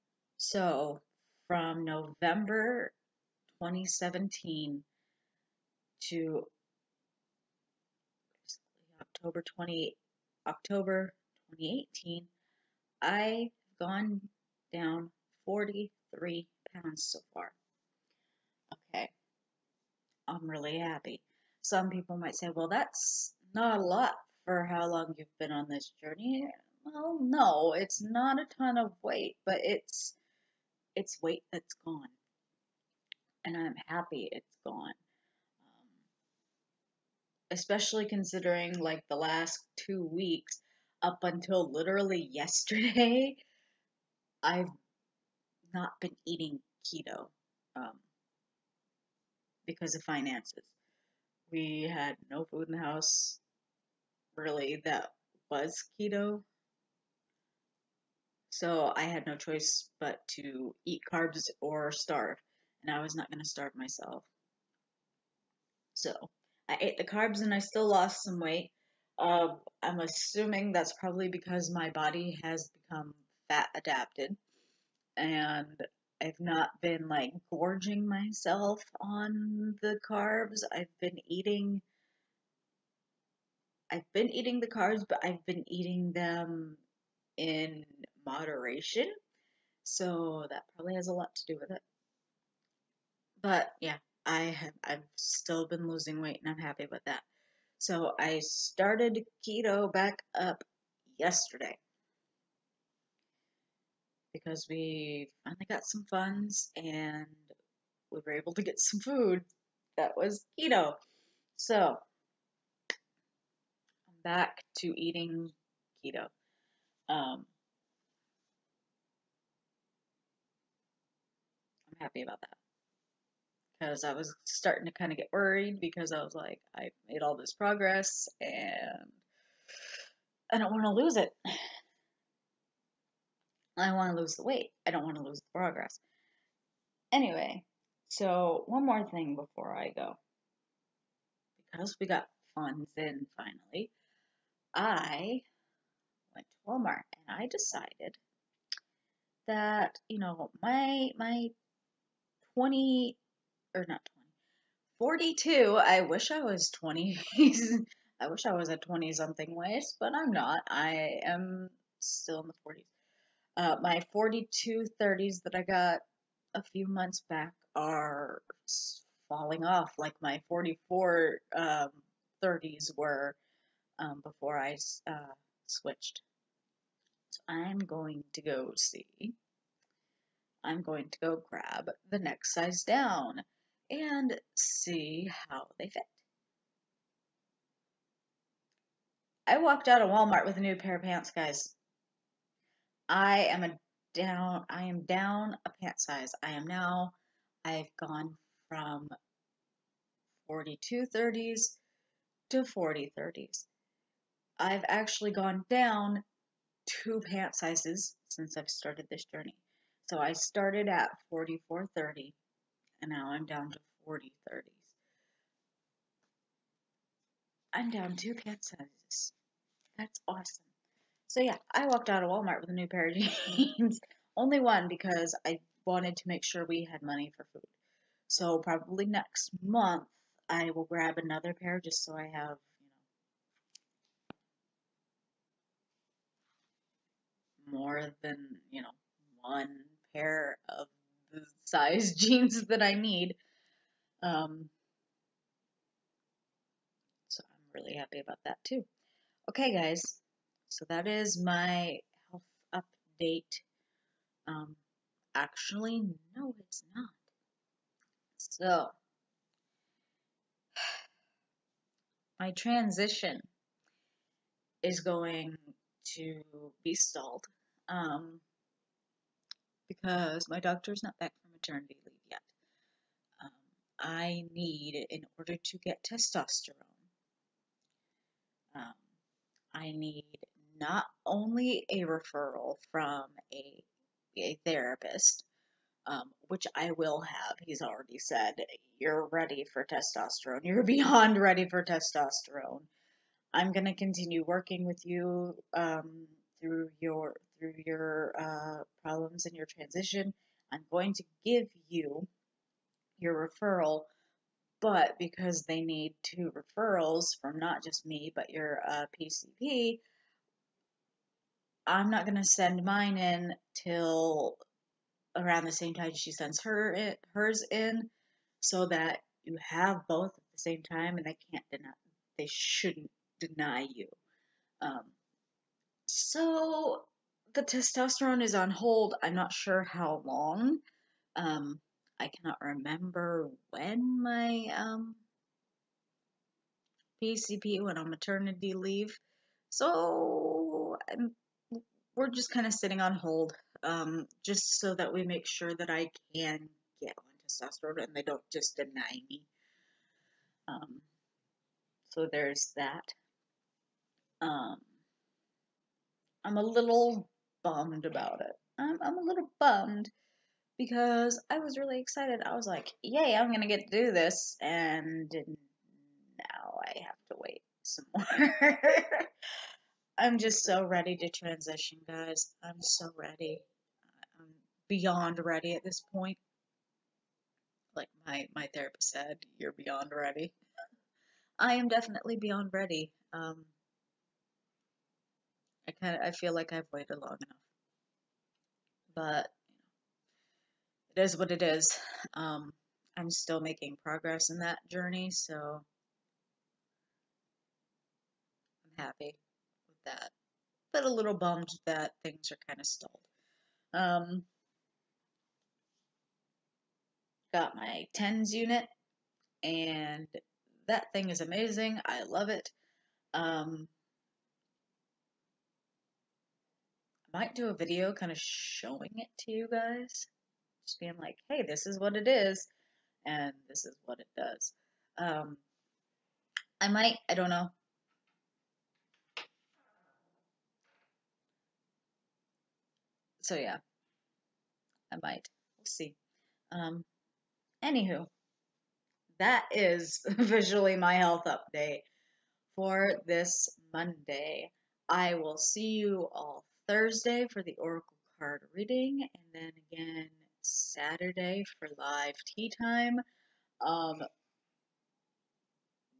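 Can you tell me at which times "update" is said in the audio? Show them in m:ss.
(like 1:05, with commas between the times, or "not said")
4:12, 7:21.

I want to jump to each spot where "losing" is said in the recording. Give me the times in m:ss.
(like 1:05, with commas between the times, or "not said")
1:35.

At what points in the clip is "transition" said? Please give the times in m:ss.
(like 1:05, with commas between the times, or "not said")
4:22, 4:59, 6:11.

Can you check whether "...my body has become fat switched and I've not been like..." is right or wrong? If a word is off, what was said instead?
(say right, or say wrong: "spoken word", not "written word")
wrong: "adapted", not "switched".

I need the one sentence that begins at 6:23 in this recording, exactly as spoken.
Um, I kind of I feel like I've waited long enough, but it is what it is.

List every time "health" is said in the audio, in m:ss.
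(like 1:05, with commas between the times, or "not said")
4:12, 7:21.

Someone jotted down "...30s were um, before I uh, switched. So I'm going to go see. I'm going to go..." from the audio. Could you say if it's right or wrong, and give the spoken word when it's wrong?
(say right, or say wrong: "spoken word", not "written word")
right.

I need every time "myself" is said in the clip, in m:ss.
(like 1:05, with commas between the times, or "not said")
1:03, 1:18.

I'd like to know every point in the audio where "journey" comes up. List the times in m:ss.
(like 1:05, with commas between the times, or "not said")
0:26, 3:29, 6:34.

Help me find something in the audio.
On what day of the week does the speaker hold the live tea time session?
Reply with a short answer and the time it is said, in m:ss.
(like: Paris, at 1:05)
Saturday, at 7:30.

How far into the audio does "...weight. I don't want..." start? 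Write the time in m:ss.
2:14.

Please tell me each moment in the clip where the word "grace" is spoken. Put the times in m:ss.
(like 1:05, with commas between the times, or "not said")
not said.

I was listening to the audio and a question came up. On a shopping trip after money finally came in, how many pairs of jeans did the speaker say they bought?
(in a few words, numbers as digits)
1.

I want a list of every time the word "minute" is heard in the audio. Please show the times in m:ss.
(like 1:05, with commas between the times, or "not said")
not said.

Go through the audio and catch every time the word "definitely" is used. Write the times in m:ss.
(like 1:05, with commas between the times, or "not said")
6:21.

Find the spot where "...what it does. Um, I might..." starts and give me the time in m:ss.
7:04.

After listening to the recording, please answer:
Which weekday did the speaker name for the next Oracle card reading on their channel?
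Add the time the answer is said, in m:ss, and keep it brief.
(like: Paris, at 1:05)
Thursday, at 7:26.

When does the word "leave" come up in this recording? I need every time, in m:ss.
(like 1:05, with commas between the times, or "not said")
4:32, 5:38.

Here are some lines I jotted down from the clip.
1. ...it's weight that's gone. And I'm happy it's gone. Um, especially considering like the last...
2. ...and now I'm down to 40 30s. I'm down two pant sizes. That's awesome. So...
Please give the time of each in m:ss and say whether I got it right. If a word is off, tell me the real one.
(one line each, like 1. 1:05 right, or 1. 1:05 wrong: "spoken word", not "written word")
1. 0:30 right
2. 3:33 right.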